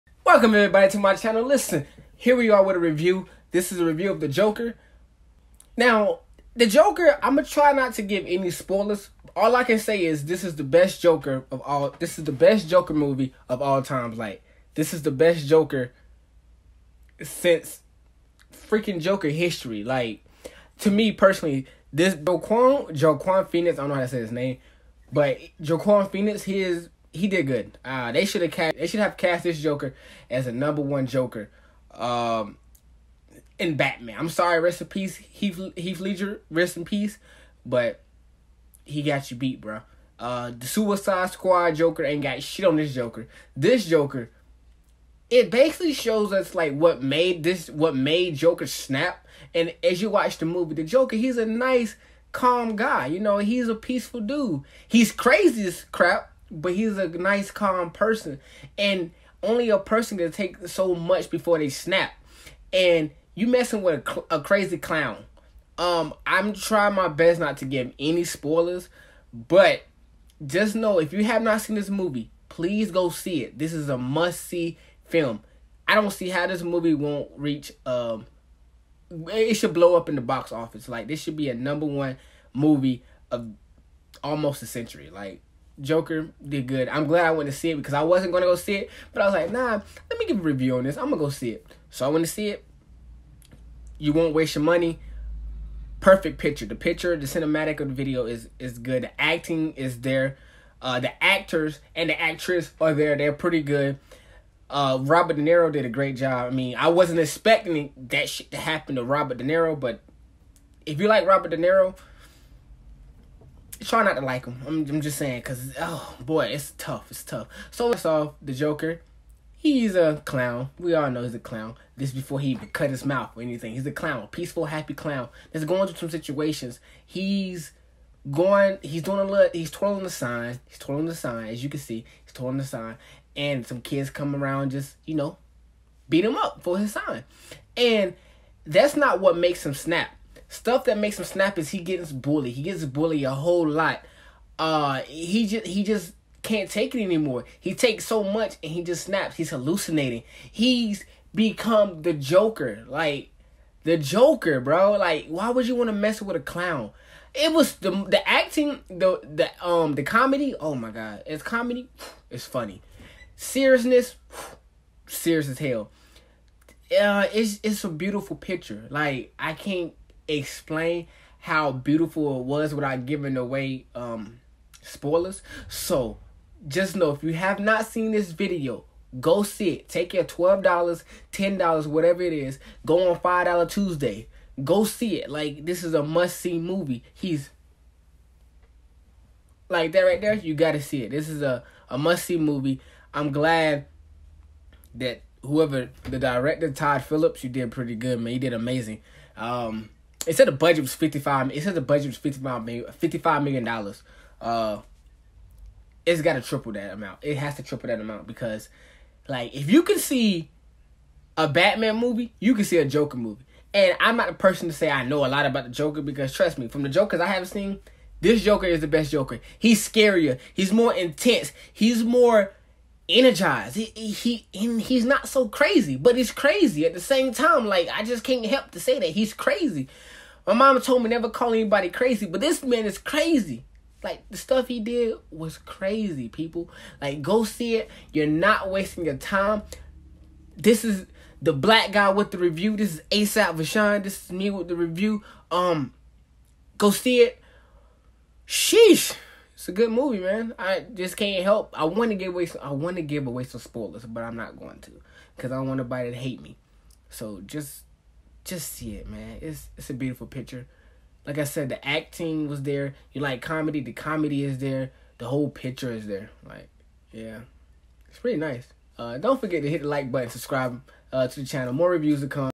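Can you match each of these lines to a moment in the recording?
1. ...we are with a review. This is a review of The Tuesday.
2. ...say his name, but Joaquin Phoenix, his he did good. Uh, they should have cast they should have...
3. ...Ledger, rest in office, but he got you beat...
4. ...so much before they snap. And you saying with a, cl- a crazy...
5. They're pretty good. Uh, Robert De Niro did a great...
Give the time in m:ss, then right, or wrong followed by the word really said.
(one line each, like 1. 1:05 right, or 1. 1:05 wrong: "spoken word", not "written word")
1. 0:02 wrong: "Joker", not "Tuesday"
2. 0:24 right
3. 0:35 wrong: "peace", not "office"
4. 1:00 wrong: "messing", not "saying"
5. 1:43 right.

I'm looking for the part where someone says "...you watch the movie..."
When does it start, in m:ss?
0:50.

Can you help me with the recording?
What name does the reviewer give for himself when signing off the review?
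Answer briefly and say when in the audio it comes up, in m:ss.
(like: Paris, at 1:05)
ASAP Vashone, at 4:03.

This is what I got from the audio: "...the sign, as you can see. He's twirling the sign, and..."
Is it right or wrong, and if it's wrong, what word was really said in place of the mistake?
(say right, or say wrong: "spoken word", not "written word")
right.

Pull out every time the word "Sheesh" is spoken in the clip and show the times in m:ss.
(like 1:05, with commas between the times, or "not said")
4:08.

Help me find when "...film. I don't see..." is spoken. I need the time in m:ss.
1:15.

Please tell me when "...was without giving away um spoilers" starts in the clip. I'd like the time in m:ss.
2:52.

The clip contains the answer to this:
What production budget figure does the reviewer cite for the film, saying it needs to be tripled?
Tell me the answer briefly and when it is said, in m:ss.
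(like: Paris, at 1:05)
$55 million, at 3:22.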